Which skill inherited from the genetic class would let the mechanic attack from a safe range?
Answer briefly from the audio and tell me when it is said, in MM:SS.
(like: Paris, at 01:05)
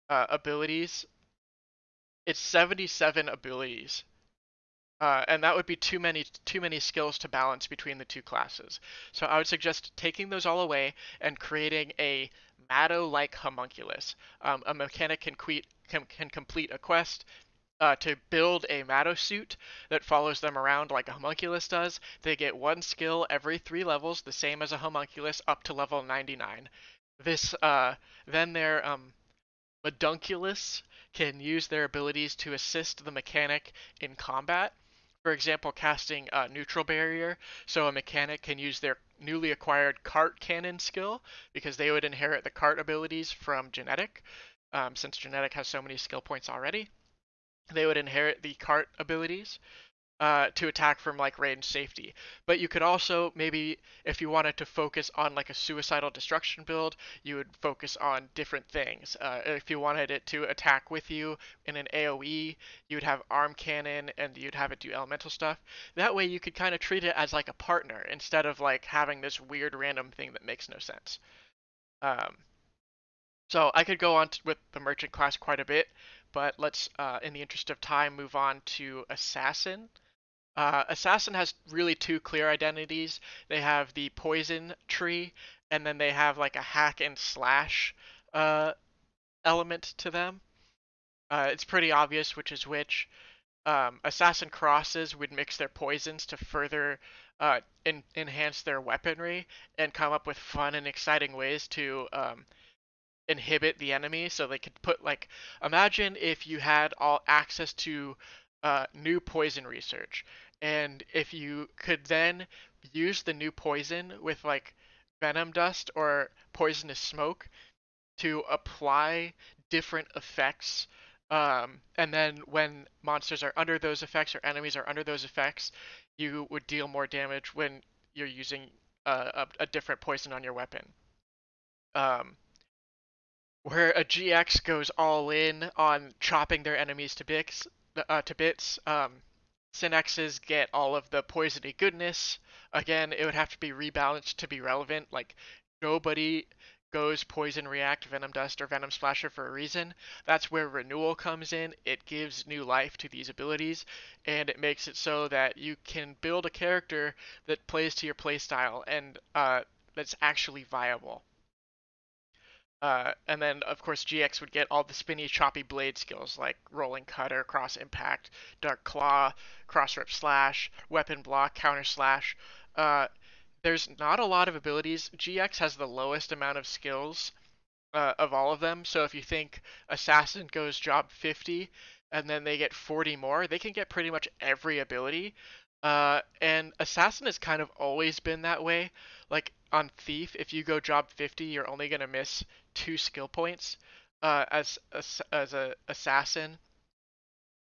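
Cart Cannon, at 00:40.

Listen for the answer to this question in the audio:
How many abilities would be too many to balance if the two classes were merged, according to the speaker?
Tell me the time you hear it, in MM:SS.
00:02.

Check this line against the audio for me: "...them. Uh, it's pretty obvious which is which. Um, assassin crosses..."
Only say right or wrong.
right.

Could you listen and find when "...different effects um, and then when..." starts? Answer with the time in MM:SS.
01:59.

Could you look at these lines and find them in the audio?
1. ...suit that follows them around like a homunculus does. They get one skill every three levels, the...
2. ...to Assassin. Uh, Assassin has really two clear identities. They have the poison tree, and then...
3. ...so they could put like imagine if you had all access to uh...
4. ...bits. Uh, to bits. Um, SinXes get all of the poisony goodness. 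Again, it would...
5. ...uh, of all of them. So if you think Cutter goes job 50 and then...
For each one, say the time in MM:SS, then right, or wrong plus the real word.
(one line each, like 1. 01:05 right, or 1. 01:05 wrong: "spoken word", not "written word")
1. 00:19 right
2. 01:18 right
3. 01:44 right
4. 02:17 right
5. 02:57 wrong: "Assassin", not "Cutter".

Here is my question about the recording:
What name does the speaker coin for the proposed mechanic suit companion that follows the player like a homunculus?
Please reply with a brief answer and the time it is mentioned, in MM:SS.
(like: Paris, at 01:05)
Madunculus, at 00:29.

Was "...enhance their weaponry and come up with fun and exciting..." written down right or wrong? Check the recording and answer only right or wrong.
right.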